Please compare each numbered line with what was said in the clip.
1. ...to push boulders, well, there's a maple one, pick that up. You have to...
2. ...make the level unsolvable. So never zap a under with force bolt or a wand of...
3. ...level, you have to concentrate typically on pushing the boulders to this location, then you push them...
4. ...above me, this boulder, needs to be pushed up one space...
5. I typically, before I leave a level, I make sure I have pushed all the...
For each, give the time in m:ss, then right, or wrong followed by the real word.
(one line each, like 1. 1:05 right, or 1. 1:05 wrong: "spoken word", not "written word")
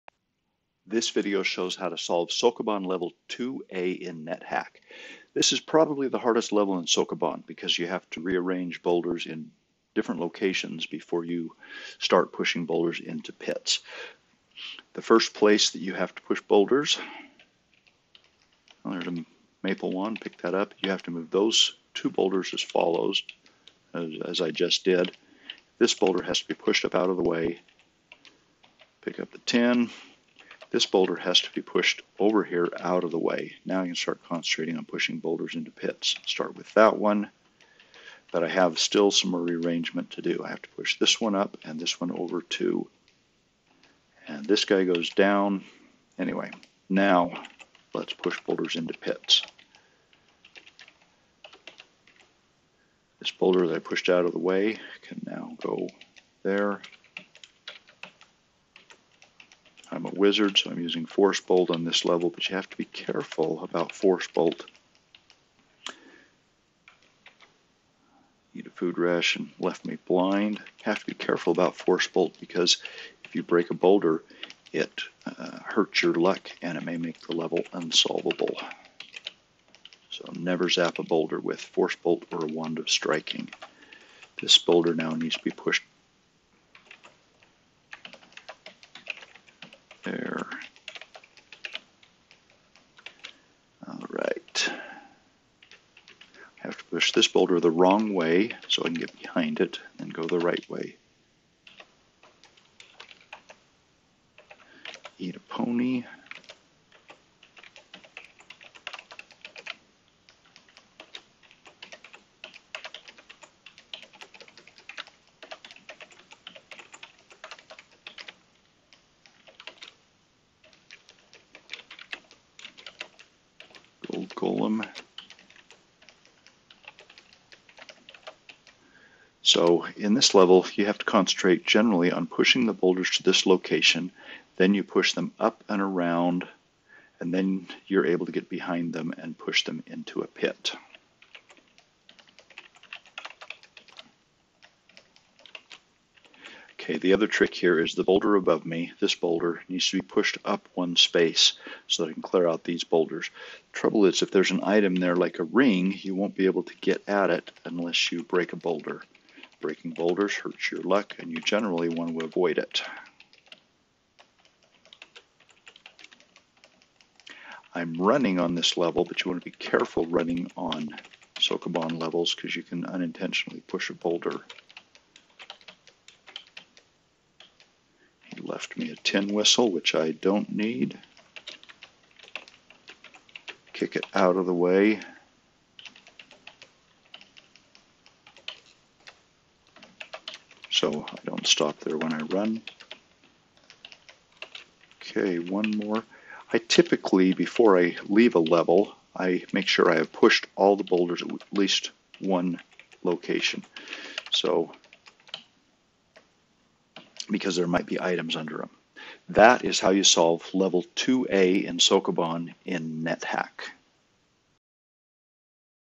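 1. 0:16 right
2. 1:16 wrong: "boulder", not "under"
3. 2:10 wrong: "generally", not "typically"
4. 2:28 right
5. 3:16 right.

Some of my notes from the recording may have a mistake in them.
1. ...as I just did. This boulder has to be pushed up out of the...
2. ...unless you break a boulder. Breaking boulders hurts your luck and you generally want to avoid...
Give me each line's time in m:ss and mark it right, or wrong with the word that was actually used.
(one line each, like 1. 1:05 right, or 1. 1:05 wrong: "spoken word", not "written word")
1. 0:24 right
2. 2:37 right.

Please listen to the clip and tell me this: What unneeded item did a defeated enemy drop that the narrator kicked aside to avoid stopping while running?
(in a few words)
Tin whistle.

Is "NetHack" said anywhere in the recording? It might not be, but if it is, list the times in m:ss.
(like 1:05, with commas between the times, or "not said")
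0:04, 3:33.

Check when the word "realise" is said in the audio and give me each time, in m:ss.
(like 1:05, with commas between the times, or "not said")
not said.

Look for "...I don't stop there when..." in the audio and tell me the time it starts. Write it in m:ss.
3:11.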